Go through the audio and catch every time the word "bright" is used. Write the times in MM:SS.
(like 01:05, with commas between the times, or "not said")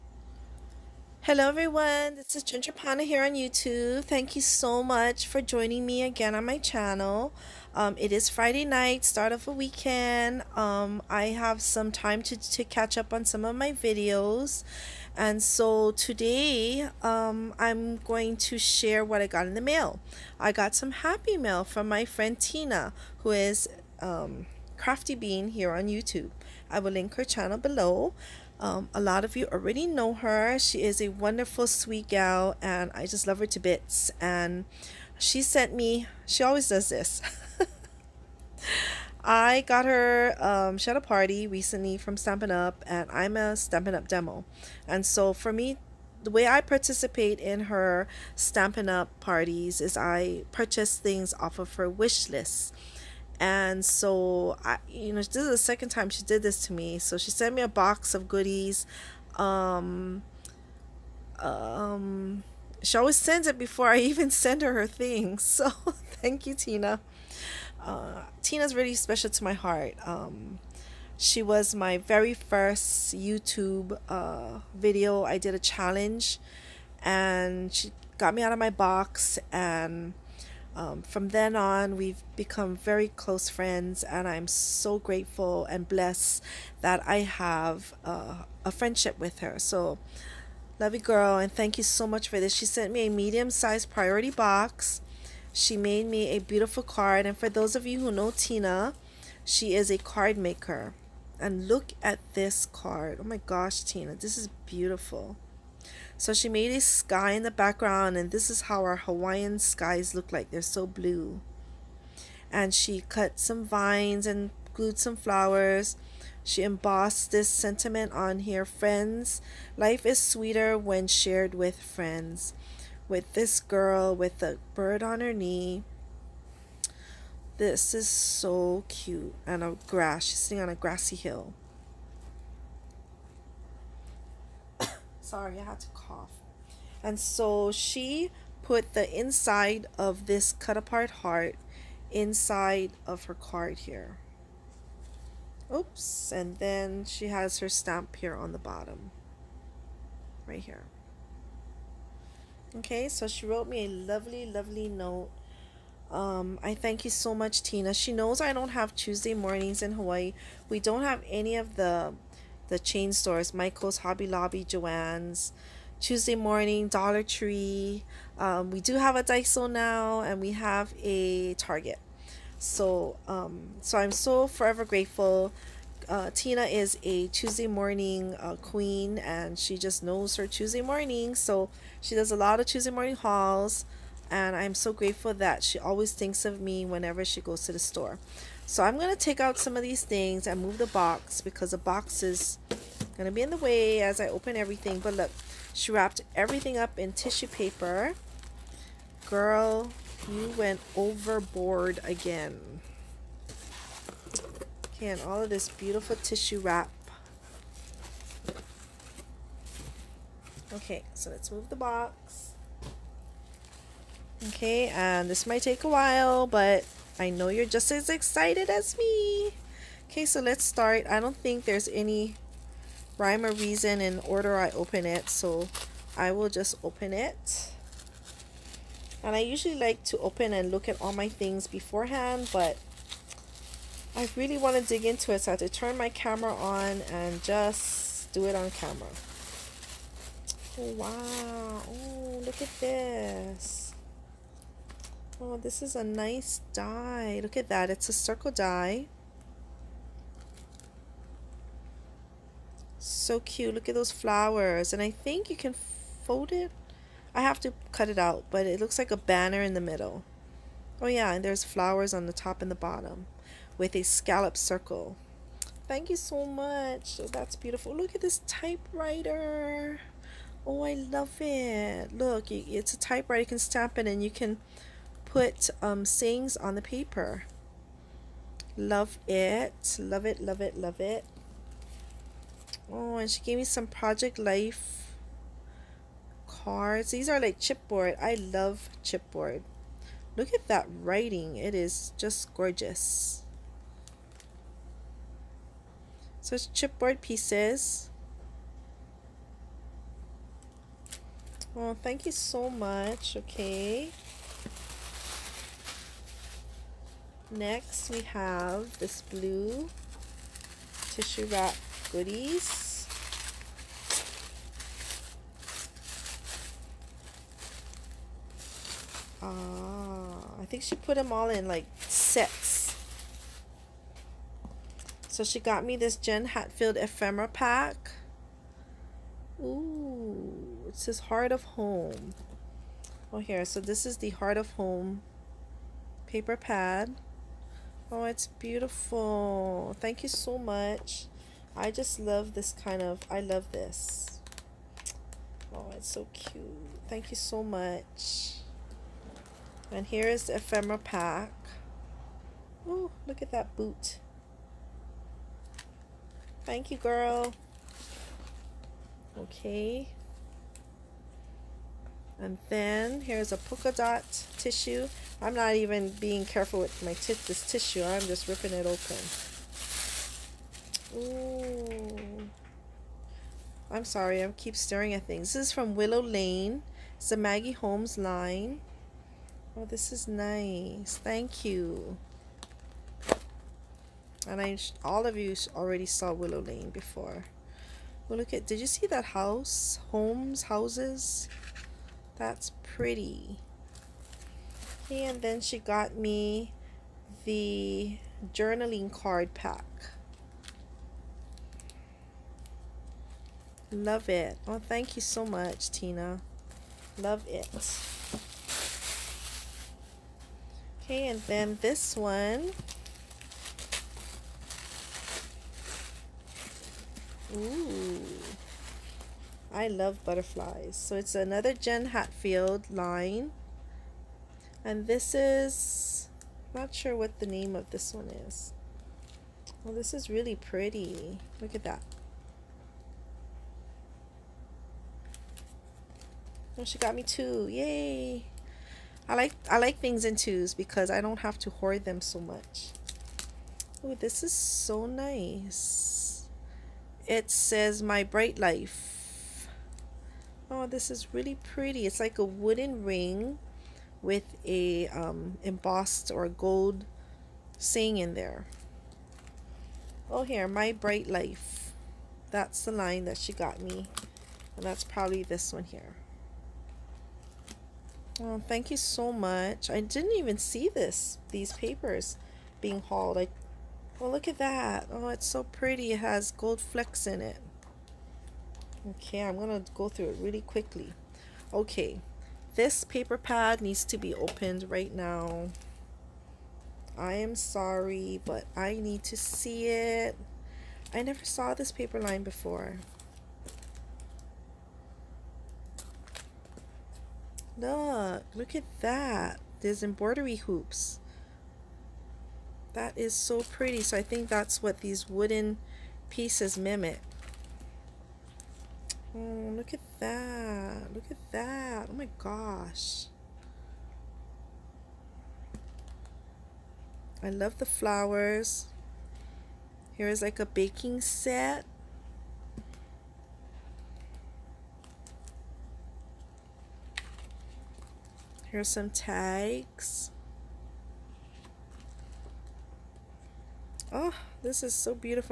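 07:28, 07:40.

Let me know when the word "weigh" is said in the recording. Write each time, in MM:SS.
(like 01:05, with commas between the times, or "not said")
not said.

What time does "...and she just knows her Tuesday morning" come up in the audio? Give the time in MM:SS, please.
02:59.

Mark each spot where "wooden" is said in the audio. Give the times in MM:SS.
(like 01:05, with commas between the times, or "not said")
07:32, 08:25.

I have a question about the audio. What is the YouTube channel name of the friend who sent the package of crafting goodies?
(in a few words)
Crafty Bean.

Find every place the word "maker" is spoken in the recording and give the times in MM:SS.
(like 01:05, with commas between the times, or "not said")
01:40.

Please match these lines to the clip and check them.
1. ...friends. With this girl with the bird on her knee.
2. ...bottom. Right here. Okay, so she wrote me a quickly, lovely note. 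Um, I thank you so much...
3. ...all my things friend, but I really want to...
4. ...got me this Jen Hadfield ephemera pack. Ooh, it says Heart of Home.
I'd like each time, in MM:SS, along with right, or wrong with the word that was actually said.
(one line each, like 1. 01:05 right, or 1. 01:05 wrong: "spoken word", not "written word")
1. 02:01 right
2. 02:28 wrong: "lovely", not "quickly"
3. 03:51 wrong: "beforehand", not "friend"
4. 05:25 right.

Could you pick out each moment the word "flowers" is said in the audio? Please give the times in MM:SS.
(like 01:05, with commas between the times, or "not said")
01:55, 04:14, 04:21, 08:37.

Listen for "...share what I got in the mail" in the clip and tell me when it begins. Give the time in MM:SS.
00:18.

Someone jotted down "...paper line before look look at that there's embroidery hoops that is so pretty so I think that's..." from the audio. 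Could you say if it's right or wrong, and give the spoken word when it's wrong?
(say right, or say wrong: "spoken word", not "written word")
right.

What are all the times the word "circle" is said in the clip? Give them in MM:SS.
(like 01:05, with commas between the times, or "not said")
04:08, 04:24.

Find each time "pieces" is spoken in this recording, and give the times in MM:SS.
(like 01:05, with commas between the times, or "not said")
04:57, 08:26.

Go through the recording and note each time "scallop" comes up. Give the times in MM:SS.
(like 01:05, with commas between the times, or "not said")
04:24.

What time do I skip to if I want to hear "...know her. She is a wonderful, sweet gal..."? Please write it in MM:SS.
00:29.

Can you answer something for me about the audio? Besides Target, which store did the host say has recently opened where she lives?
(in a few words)
Daiso.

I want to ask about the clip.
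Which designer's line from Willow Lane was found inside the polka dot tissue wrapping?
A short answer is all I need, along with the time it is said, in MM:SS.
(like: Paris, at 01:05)
Maggie Holmes, at 06:17.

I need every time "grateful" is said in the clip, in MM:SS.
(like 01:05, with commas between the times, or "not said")
01:24, 02:54, 03:04.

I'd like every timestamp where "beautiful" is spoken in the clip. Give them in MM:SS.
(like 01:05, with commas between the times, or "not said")
01:36, 01:44, 03:25, 04:27, 05:38.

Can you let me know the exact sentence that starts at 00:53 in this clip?
And so, I, you know, this is the second time she did this to me.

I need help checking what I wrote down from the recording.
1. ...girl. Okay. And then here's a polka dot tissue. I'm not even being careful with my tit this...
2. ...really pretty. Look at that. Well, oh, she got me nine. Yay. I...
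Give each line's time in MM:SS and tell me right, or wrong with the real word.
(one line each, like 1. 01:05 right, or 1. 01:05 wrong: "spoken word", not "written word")
1. 05:56 right
2. 07:10 wrong: "two", not "nine".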